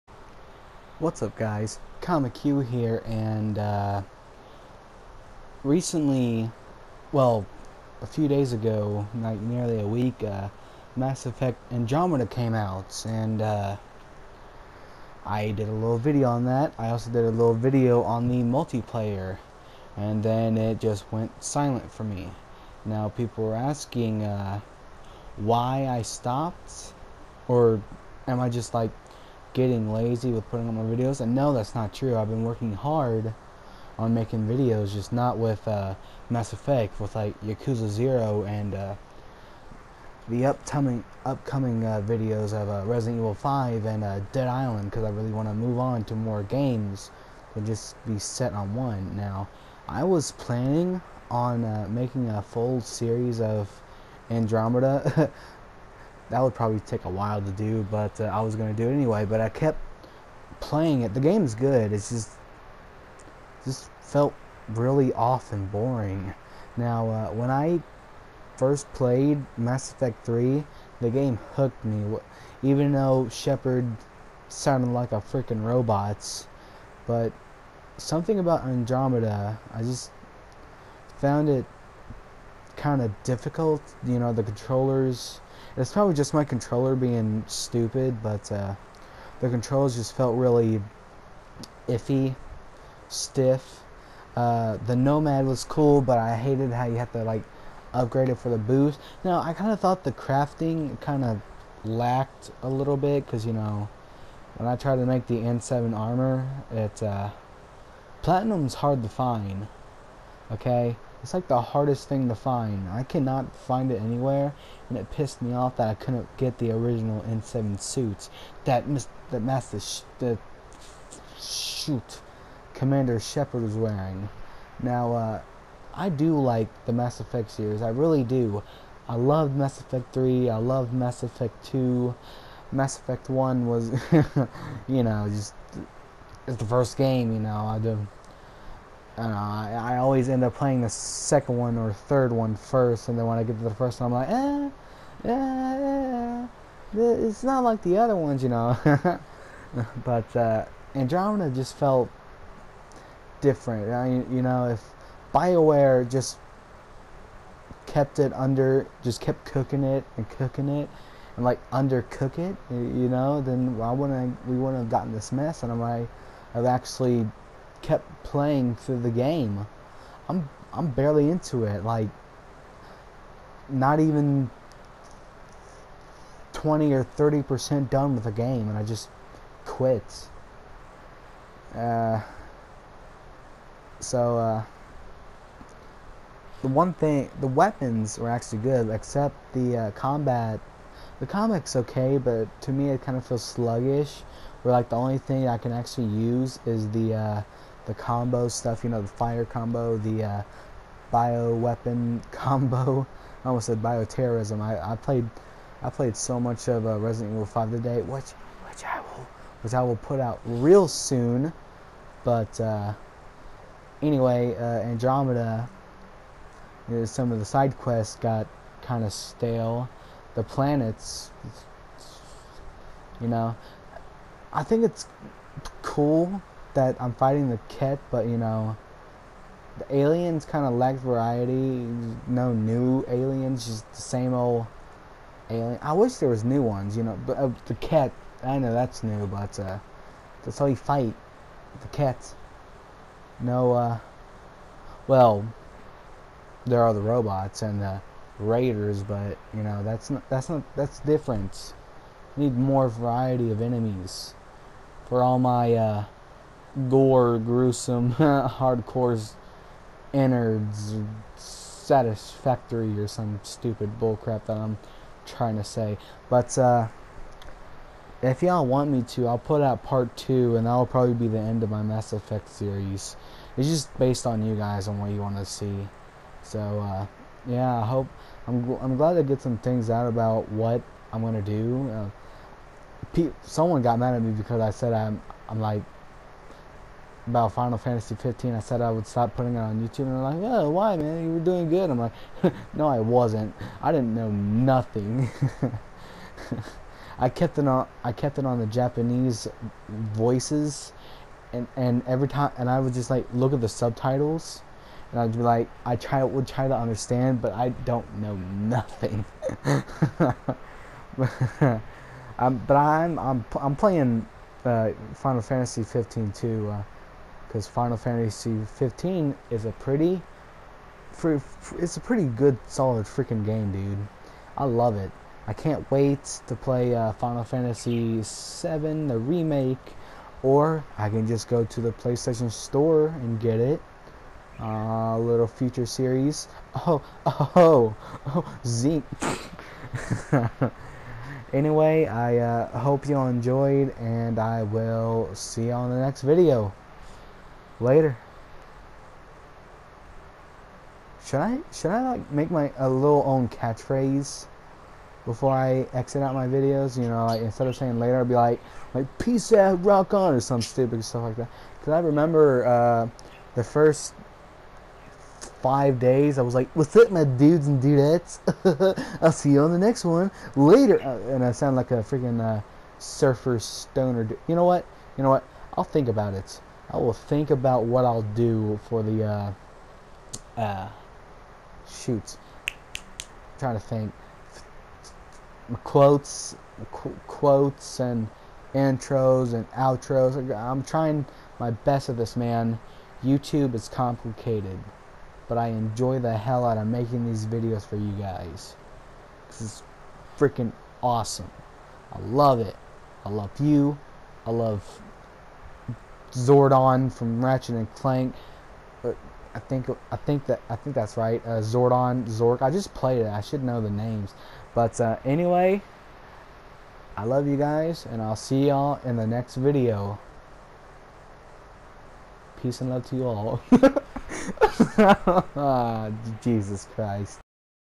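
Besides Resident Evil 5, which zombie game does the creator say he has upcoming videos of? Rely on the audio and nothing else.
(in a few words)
Dead Island.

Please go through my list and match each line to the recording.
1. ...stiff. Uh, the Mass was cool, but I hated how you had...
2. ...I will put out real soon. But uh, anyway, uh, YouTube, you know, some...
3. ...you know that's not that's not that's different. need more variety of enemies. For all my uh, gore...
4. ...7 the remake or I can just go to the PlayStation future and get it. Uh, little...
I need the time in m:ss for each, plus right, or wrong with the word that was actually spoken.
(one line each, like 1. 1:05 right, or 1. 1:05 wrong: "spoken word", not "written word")
1. 1:33 wrong: "Nomad", not "Mass"
2. 3:29 wrong: "Andromeda", not "YouTube"
3. 4:09 right
4. 5:28 wrong: "store", not "future".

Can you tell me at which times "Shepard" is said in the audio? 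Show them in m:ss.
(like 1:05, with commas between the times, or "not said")
1:13, 2:03.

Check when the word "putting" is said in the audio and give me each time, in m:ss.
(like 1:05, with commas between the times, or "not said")
0:30, 4:49.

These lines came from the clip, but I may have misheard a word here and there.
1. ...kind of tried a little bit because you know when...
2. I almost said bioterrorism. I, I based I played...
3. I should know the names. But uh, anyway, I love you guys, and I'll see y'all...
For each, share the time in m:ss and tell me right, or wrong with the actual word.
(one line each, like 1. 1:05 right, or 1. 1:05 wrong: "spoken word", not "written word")
1. 1:41 wrong: "lacked", not "tried"
2. 3:23 wrong: "played", not "based"
3. 6:53 right.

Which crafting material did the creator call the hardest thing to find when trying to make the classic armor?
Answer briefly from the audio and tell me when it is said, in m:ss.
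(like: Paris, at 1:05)
Platinum, at 1:48.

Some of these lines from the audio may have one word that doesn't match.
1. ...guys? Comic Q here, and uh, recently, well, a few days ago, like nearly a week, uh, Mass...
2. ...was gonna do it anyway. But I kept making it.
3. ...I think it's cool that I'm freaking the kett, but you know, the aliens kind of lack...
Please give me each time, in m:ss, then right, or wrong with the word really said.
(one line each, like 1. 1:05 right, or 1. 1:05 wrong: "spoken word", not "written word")
1. 0:01 right
2. 0:58 wrong: "playing", not "making"
3. 3:44 wrong: "fighting", not "freaking".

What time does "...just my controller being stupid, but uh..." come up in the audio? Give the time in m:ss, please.
1:26.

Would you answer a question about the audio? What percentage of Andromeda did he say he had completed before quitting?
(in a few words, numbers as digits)
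20 or 30%.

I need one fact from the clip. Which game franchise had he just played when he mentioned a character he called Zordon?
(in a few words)
Ratchet and Clank.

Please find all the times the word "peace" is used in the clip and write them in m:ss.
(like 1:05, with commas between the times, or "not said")
5:59, 7:02.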